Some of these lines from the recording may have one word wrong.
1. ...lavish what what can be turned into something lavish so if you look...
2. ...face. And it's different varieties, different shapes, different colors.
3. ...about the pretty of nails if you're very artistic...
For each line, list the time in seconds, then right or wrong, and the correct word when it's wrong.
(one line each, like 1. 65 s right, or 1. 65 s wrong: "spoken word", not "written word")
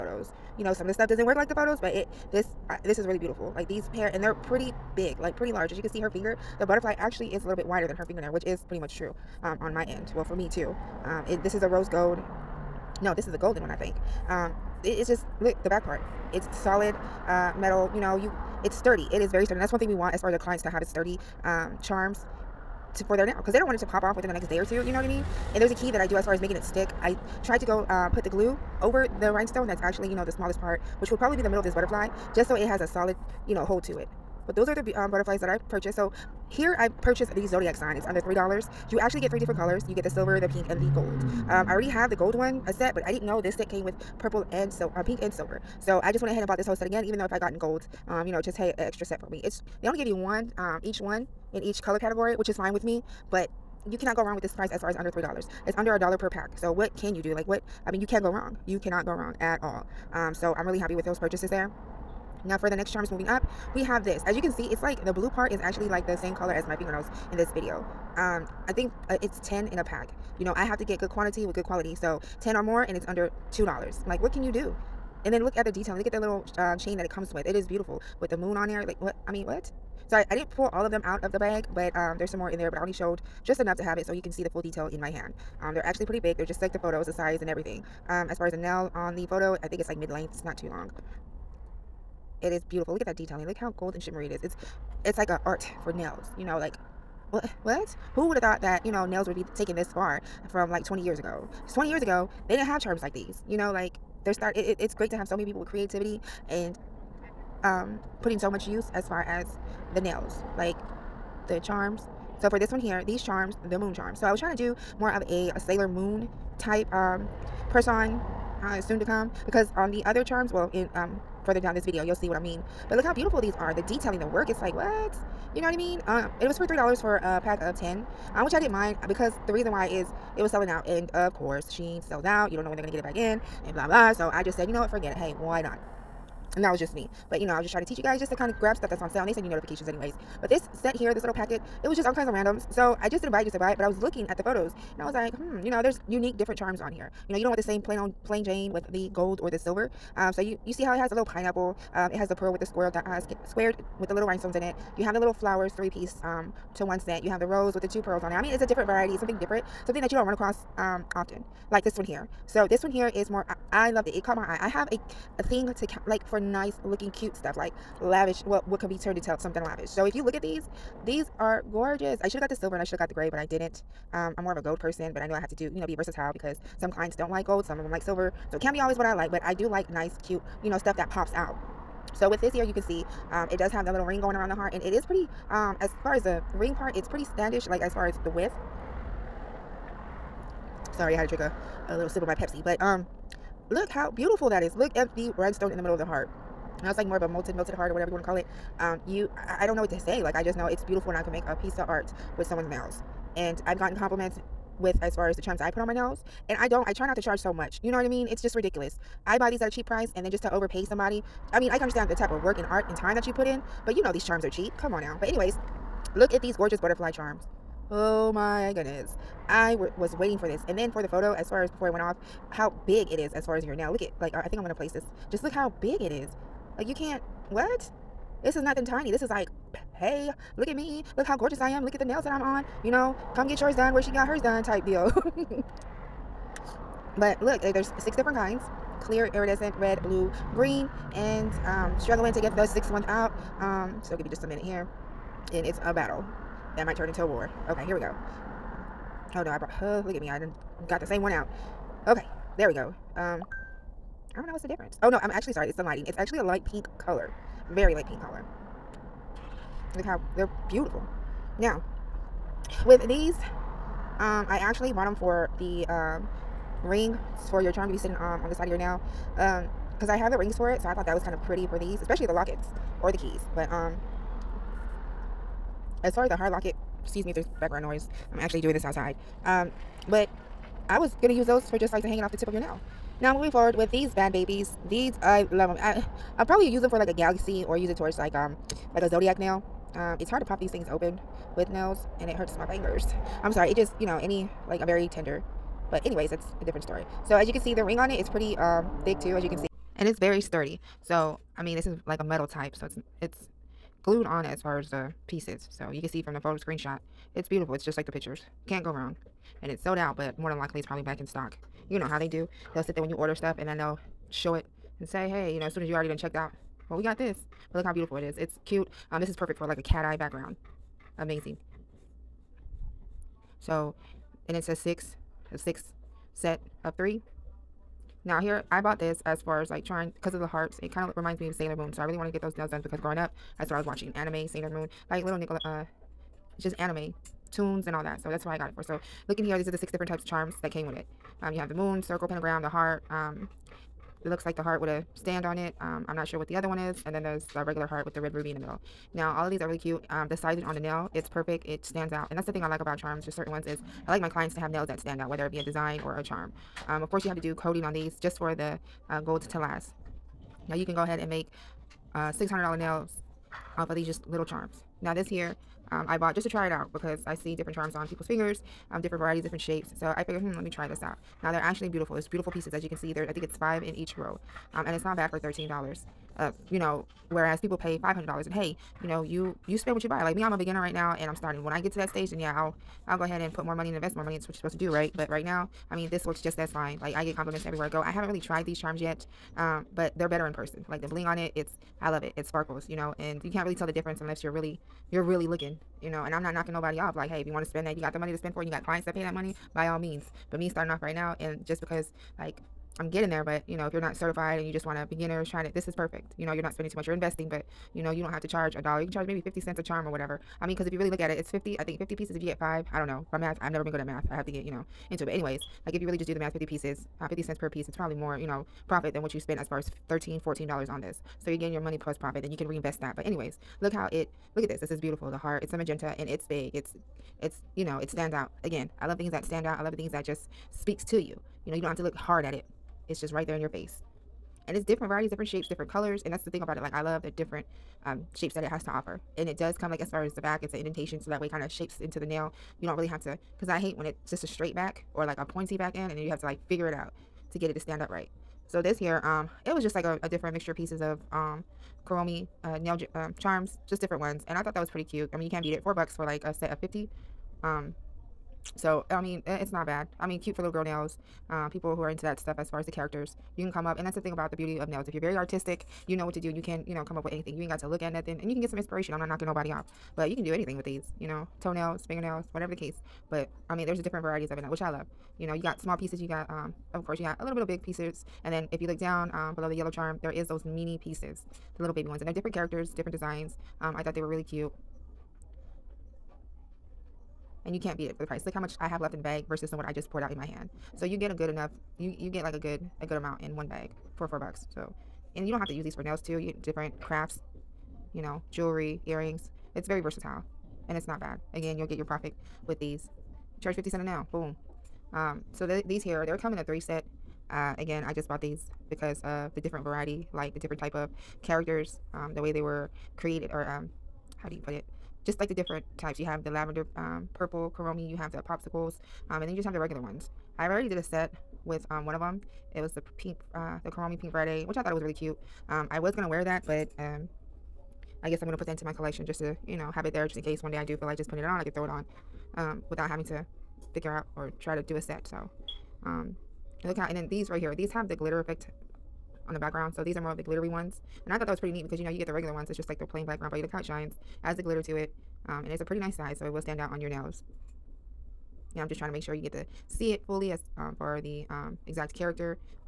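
1. 168 s right
2. 433 s right
3. 464 s wrong: "beauty", not "pretty".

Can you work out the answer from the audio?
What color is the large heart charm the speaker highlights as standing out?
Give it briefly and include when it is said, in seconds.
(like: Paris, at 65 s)
Magenta, at 425 s.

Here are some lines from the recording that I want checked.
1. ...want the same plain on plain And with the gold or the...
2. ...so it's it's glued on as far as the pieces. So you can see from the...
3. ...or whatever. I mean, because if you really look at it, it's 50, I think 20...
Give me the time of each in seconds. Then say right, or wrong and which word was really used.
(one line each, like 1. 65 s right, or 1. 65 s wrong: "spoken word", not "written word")
1. 147 s wrong: "Jane", not "And"
2. 302 s right
3. 410 s wrong: "50", not "20".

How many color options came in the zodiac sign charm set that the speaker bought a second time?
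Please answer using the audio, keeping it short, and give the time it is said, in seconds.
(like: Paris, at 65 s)
3, at 39 s.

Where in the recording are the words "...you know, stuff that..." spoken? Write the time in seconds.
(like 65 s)
180 s.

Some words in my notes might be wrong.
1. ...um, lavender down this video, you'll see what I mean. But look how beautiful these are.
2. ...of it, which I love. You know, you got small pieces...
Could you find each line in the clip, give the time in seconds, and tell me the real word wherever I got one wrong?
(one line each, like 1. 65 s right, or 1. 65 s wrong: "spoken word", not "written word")
1. 120 s wrong: "further", not "lavender"
2. 474 s right.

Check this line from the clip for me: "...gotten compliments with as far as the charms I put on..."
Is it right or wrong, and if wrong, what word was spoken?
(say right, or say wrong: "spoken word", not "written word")
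right.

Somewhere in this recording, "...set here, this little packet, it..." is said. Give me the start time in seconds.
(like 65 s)
140 s.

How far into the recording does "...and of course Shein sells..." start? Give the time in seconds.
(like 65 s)
130 s.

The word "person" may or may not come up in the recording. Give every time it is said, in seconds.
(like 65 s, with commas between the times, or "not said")
117 s, 174 s, 390 s.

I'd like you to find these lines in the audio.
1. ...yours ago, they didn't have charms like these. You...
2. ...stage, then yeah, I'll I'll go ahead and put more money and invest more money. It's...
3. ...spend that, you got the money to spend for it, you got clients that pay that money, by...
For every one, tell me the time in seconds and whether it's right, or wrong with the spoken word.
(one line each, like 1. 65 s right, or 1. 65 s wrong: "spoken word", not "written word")
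1. 101 s wrong: "years", not "yours"
2. 382 s right
3. 397 s right.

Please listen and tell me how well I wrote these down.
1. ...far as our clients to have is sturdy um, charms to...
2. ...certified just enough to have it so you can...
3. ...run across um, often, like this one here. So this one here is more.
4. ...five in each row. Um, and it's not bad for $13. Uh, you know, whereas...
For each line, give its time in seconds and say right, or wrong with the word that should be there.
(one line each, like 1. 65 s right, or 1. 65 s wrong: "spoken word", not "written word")
1. 20 s right
2. 82 s wrong: "showed", not "certified"
3. 160 s right
4. 373 s right.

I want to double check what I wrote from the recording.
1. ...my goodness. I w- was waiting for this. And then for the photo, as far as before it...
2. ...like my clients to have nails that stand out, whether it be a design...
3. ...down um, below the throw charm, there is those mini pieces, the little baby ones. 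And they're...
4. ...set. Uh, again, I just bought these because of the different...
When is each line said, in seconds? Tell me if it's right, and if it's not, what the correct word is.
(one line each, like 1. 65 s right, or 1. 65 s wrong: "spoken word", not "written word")
1. 218 s right
2. 354 s right
3. 479 s wrong: "yellow", not "throw"
4. 506 s right.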